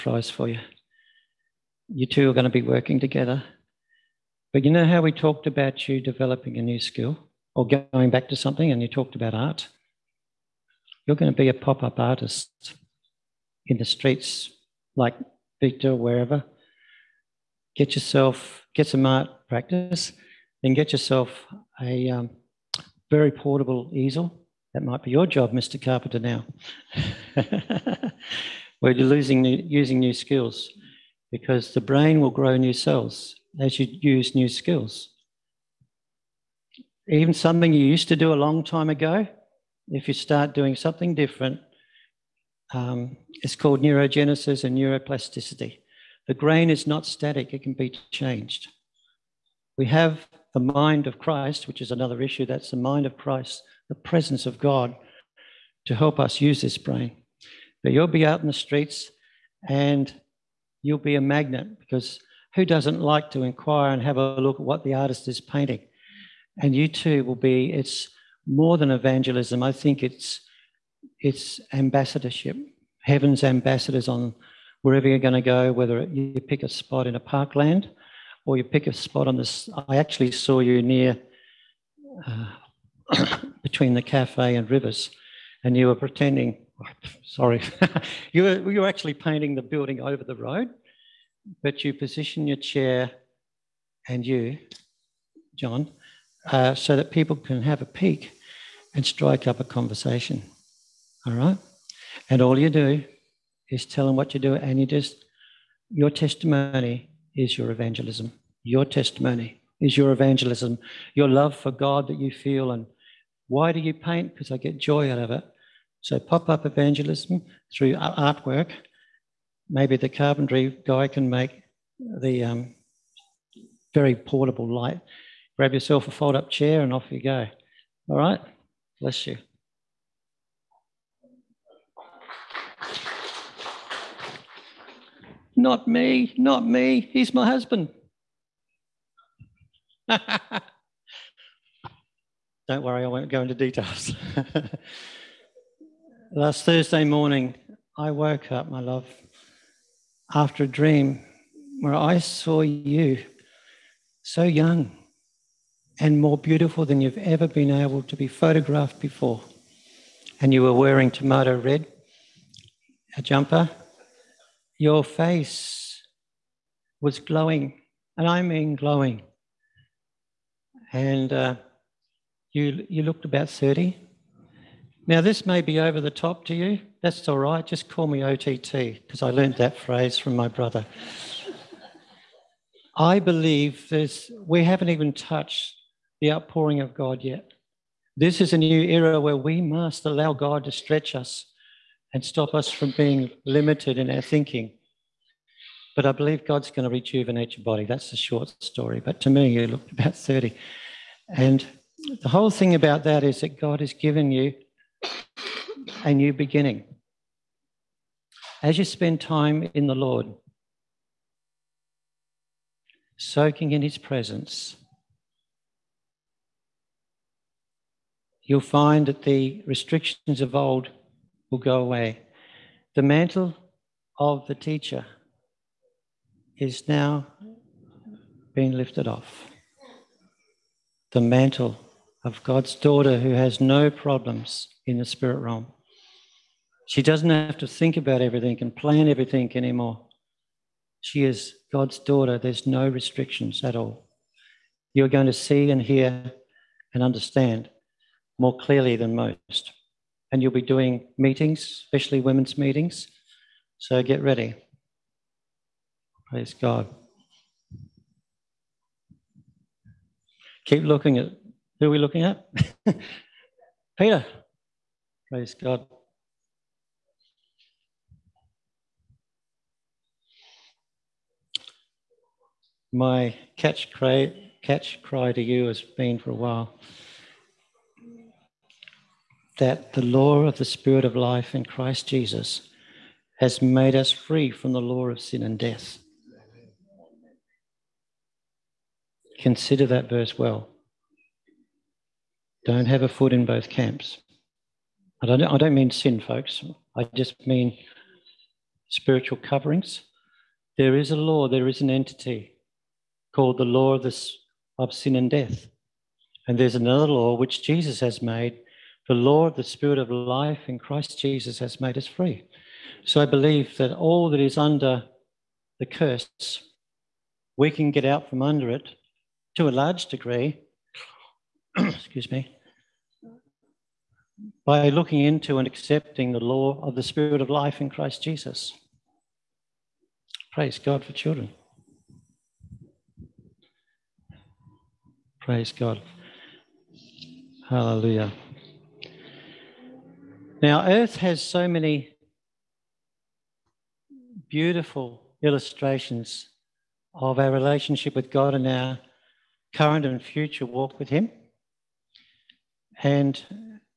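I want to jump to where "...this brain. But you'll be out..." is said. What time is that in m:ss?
0:56.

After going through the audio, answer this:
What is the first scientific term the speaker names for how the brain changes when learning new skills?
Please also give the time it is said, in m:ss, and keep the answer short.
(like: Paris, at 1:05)
neurogenesis, at 0:43.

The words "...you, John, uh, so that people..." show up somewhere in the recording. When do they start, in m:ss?
1:34.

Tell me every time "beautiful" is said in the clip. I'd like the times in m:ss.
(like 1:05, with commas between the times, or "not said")
2:36, 5:44.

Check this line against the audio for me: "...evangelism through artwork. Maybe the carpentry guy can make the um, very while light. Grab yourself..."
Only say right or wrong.
wrong.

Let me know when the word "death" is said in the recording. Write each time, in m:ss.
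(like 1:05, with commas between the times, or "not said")
4:45, 5:05.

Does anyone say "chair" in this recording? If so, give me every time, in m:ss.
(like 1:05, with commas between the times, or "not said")
1:32, 2:06.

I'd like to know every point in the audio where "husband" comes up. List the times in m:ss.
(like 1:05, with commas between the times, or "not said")
2:17.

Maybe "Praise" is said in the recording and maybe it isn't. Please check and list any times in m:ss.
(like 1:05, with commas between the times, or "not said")
4:16, 4:25, 5:30, 5:35.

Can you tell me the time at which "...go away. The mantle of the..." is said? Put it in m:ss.
3:41.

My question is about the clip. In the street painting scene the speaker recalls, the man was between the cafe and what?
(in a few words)
rivers.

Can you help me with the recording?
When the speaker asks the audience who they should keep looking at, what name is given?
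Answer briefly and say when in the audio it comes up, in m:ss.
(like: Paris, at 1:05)
Peter, at 4:23.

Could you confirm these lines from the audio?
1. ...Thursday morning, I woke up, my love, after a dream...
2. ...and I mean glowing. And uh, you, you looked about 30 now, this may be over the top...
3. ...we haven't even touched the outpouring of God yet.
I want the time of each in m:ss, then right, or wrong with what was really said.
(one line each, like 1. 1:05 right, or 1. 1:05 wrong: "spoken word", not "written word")
1. 2:26 right
2. 2:48 right
3. 3:04 right.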